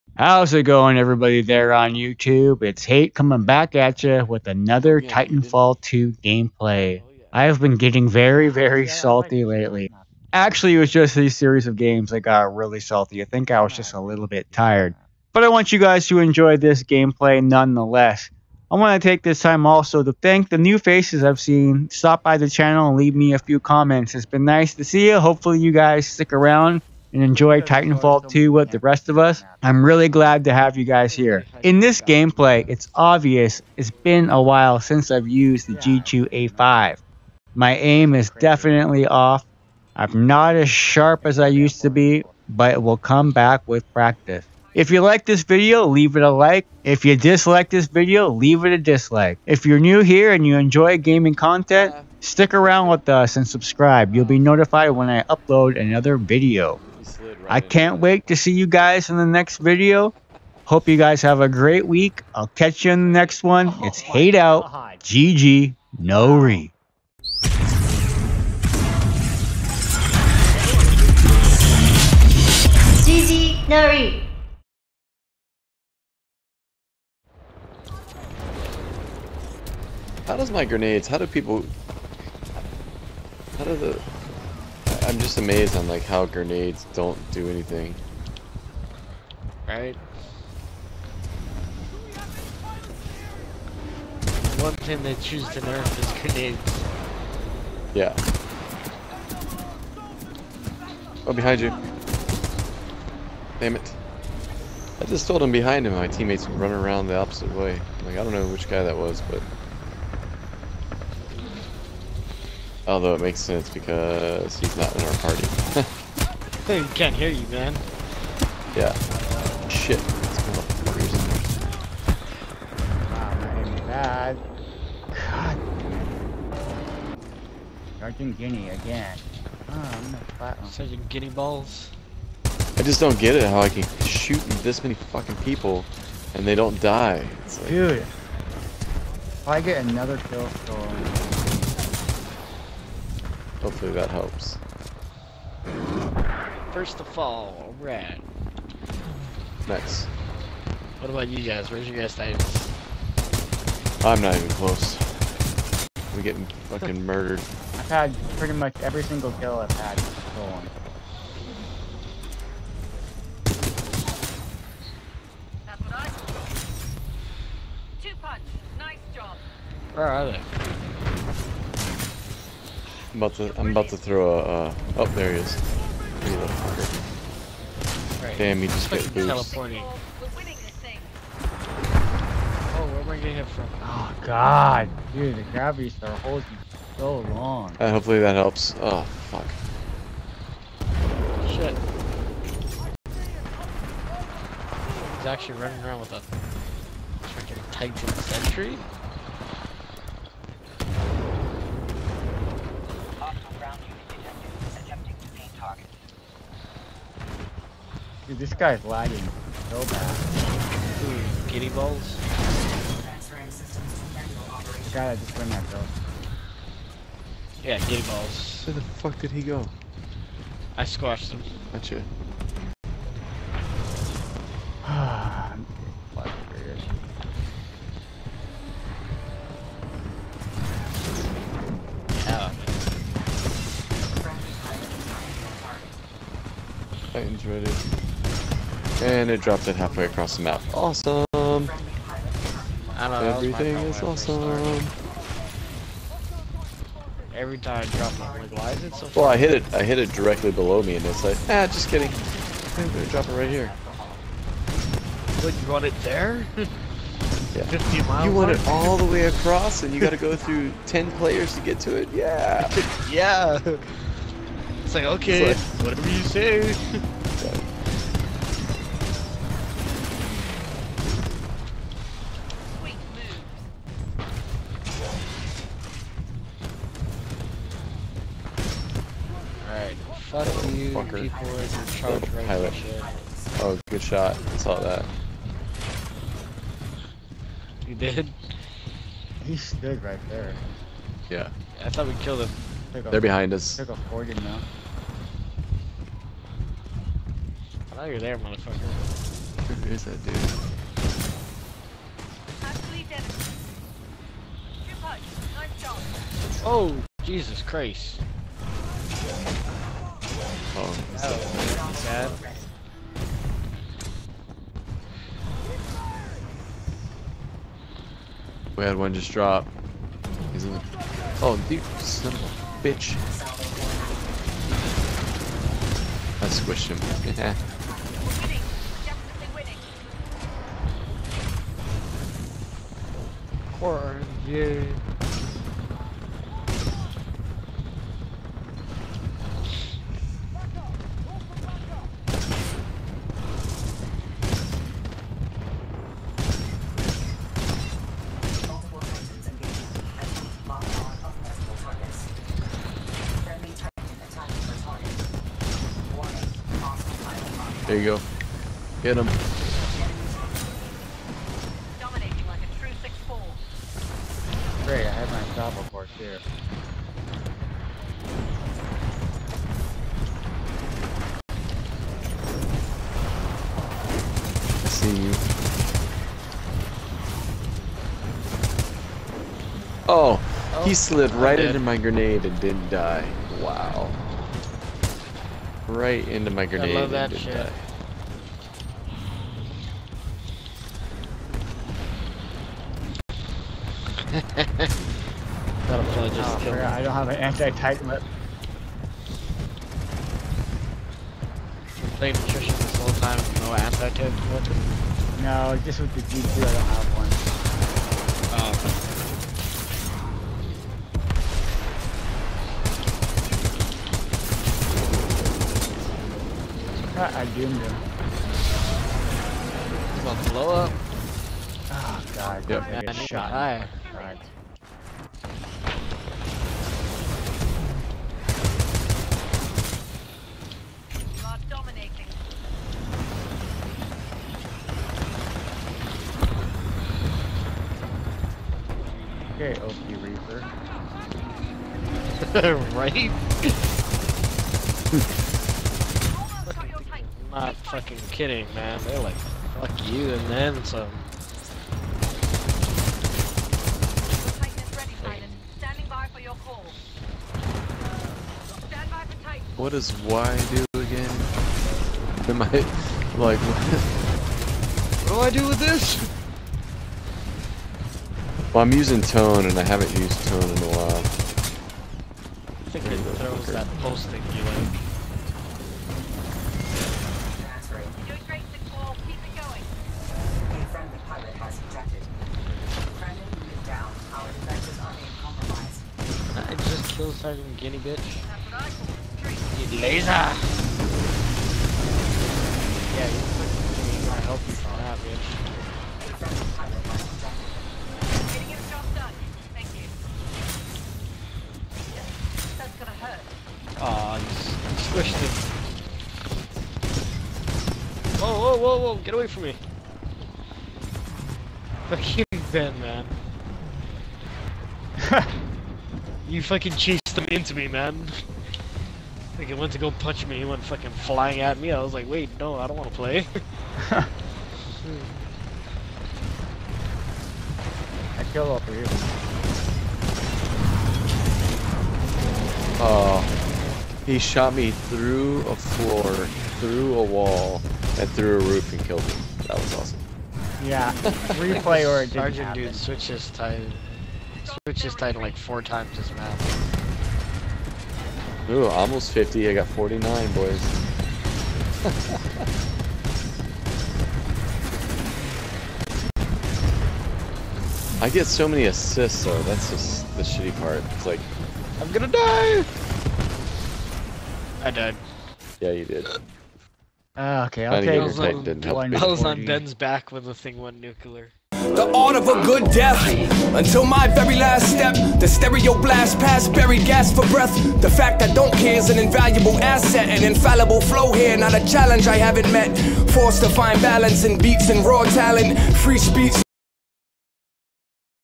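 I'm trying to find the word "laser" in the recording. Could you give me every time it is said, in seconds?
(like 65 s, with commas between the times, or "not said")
489 s.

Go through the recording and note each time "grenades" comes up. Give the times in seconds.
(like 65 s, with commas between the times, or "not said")
80 s, 86 s, 96 s, 381 s, 386 s.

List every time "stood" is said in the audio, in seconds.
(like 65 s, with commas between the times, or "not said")
289 s.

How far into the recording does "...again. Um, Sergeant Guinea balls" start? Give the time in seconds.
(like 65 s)
128 s.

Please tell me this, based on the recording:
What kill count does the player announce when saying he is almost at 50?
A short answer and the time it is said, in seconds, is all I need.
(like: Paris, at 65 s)
49, at 549 s.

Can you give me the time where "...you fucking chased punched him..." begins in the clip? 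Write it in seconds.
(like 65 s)
516 s.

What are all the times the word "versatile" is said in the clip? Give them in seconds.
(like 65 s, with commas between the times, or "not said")
not said.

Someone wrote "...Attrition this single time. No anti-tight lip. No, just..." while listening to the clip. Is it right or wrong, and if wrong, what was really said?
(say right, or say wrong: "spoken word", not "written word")
wrong: "whole", not "single".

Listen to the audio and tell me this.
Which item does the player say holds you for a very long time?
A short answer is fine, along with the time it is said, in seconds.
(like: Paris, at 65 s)
Gravity star, at 185 s.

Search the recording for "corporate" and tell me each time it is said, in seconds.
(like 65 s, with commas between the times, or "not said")
not said.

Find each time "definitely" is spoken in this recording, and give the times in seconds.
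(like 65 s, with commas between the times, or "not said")
38 s.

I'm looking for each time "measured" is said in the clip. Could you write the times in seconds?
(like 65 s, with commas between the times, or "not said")
not said.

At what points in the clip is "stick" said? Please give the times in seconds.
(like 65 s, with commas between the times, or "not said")
26 s, 52 s.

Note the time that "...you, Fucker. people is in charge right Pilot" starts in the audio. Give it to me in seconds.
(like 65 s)
280 s.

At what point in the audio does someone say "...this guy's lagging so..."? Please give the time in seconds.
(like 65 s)
208 s.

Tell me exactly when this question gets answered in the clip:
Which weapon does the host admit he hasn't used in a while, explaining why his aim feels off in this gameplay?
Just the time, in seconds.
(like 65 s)
35 s.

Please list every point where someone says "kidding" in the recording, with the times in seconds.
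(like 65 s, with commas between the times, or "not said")
251 s, 448 s.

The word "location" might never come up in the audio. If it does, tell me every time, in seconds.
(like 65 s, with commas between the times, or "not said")
not said.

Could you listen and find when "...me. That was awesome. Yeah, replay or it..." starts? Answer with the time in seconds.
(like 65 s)
539 s.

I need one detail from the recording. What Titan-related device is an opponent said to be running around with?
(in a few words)
Titan sentry.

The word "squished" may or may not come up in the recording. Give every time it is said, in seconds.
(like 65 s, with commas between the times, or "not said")
326 s, 505 s.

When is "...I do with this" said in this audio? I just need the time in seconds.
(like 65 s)
465 s.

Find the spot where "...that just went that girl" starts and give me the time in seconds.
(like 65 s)
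215 s.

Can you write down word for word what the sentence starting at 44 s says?
If you like this video, leave it a like.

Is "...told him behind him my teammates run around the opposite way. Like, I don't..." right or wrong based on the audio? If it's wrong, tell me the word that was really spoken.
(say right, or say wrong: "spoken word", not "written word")
right.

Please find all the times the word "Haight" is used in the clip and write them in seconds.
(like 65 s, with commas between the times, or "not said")
2 s, 63 s.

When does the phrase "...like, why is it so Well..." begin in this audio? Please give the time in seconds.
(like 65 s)
248 s.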